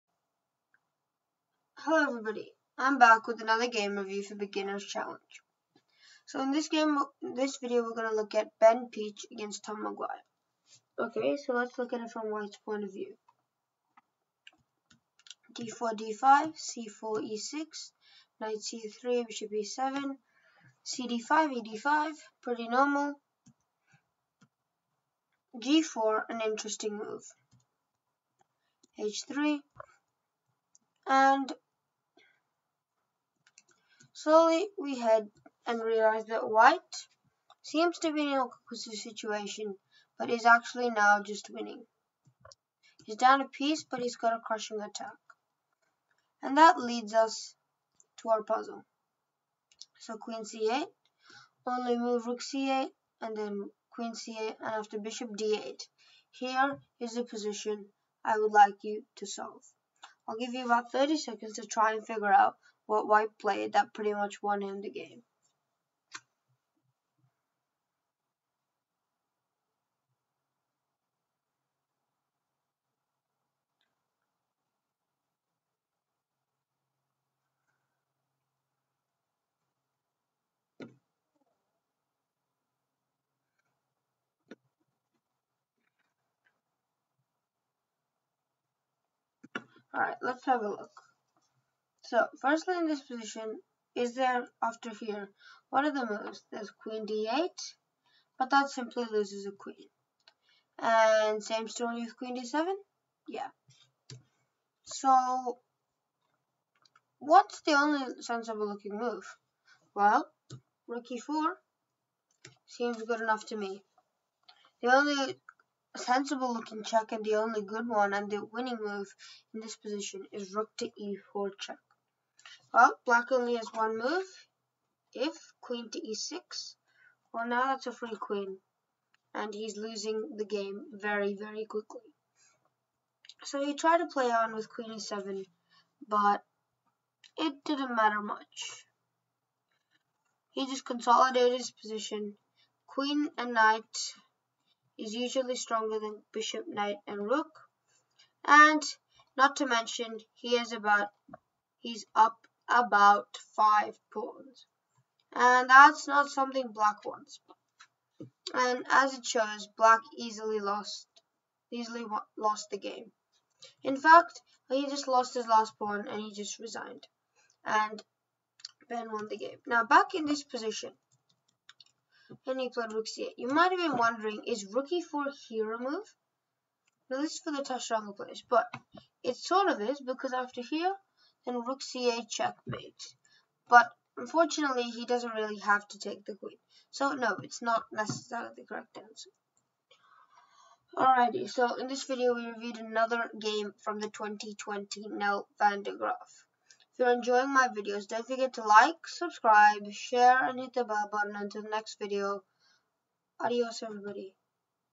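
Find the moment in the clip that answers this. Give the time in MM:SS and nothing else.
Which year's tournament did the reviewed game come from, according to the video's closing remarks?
03:14.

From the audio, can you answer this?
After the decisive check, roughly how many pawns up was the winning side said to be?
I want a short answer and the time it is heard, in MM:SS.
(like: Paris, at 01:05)
5, at 02:33.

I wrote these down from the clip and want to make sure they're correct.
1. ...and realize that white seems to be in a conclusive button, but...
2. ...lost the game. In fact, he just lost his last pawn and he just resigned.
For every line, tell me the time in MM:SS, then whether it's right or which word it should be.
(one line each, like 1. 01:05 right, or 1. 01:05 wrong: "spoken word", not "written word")
1. 00:35 wrong: "situation", not "button"
2. 02:42 right.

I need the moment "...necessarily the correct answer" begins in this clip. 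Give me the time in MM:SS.
03:07.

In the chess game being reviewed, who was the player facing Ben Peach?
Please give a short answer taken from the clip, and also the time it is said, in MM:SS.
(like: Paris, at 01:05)
Tom McGuire, at 00:09.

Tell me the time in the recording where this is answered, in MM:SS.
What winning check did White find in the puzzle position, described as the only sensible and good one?
02:00.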